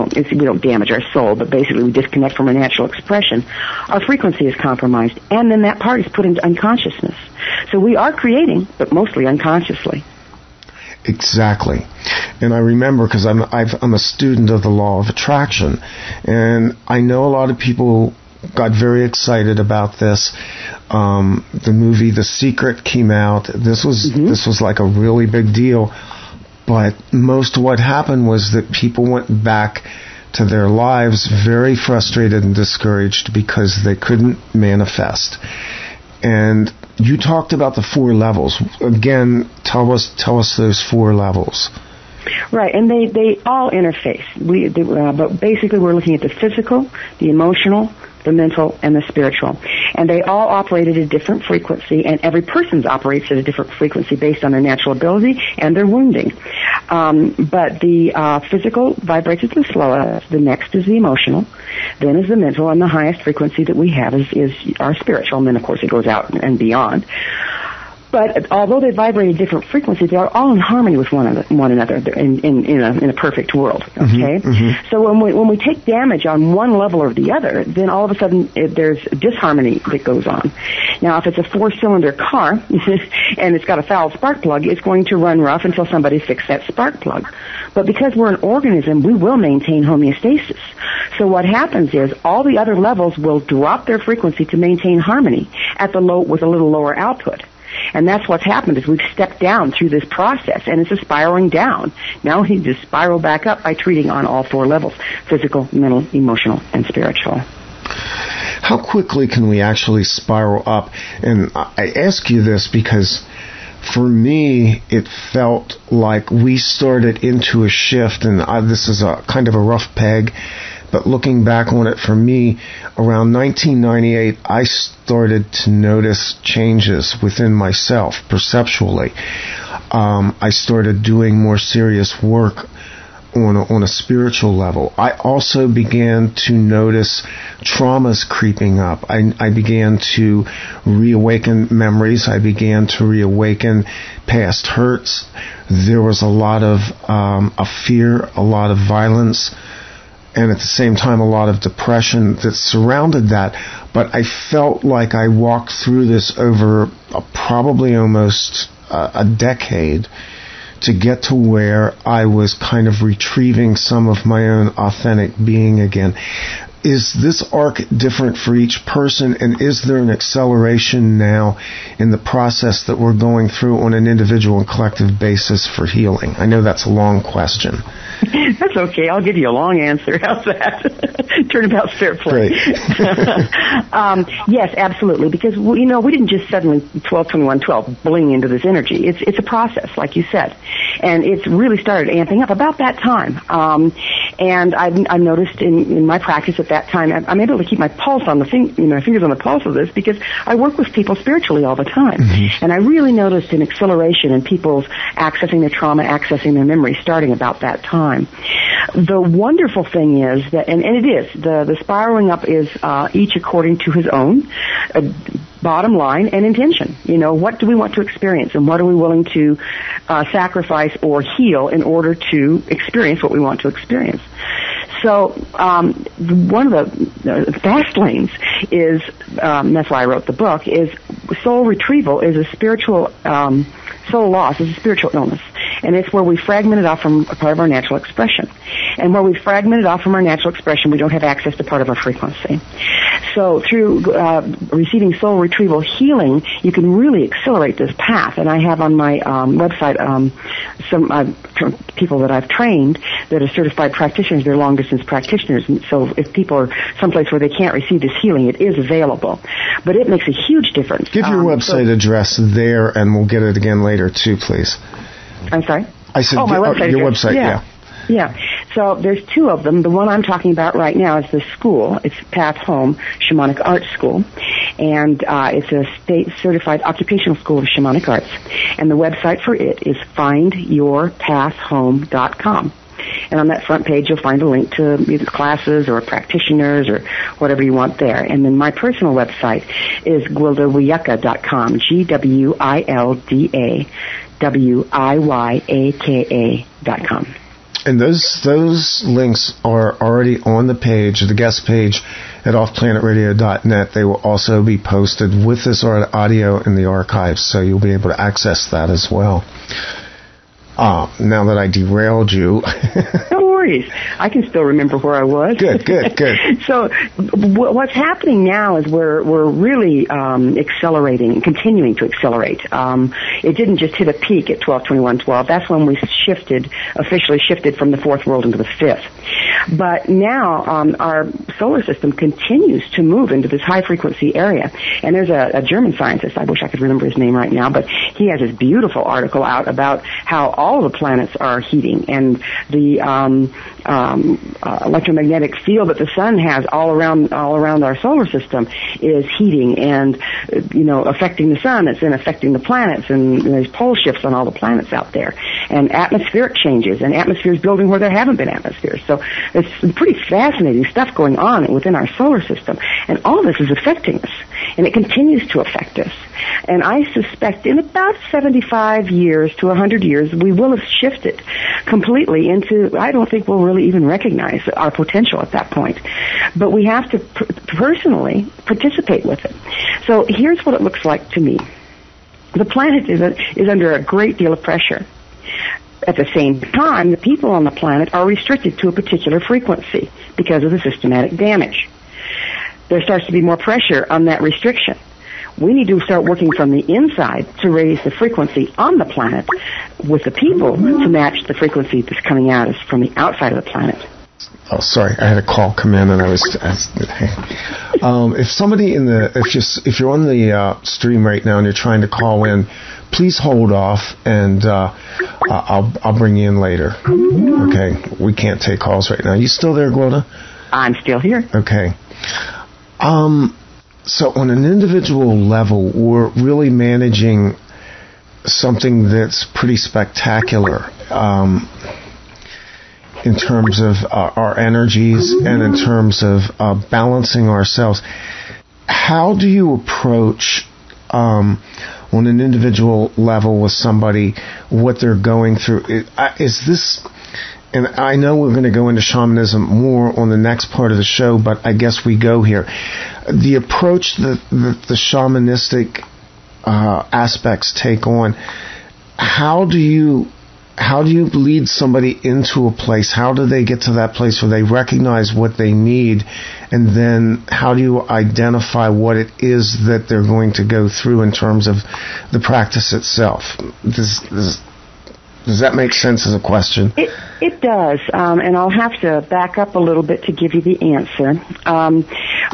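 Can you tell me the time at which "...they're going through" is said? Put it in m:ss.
7:25.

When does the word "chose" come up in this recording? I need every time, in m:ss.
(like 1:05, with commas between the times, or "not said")
not said.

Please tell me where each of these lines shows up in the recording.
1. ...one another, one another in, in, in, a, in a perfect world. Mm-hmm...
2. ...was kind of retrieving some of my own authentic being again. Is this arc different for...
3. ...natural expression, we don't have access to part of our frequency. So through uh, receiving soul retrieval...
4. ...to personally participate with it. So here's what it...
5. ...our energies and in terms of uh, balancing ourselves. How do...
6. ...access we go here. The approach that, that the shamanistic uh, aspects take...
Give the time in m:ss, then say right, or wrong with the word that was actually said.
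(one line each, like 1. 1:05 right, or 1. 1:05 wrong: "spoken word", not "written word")
1. 1:11 right
2. 2:42 right
3. 4:00 right
4. 6:17 right
5. 7:14 right
6. 7:31 wrong: "guess", not "access".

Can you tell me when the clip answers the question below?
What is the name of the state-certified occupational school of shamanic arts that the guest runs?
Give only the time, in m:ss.
4:32.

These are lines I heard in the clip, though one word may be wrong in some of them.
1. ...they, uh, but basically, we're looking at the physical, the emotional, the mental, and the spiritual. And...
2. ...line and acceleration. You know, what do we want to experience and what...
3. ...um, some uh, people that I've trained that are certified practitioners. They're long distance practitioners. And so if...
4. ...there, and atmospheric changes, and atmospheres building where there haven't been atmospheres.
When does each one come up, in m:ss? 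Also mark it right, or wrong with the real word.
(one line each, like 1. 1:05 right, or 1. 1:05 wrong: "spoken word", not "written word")
1. 0:44 right
2. 3:35 wrong: "intention", not "acceleration"
3. 4:10 right
4. 5:55 right.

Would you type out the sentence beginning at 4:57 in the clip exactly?
And those those links are already on the page, the guest page at offplanetradio.net.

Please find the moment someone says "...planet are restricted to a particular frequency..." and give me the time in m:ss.
6:27.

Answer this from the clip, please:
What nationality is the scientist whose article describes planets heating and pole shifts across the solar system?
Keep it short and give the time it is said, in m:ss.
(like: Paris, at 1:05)
German, at 5:35.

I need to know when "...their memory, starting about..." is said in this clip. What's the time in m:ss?
3:26.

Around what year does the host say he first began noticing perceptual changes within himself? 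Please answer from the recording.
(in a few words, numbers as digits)
1998.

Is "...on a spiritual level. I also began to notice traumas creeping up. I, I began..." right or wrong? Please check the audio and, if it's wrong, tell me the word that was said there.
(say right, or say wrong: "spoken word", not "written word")
right.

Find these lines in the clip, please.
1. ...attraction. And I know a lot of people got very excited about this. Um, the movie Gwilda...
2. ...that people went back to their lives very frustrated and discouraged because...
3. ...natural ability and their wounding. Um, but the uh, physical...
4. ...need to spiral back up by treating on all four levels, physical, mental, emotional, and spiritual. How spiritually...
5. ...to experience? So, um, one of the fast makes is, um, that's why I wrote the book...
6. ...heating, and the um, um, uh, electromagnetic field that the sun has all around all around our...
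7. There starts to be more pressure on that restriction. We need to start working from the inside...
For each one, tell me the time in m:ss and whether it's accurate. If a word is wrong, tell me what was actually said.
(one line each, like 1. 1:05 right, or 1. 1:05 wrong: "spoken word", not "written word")
1. 0:15 wrong: "The", not "Gwilda"
2. 0:28 right
3. 0:54 right
4. 1:42 wrong: "quickly", not "spiritually"
5. 3:43 wrong: "lanes", not "makes"
6. 5:41 right
7. 6:32 right.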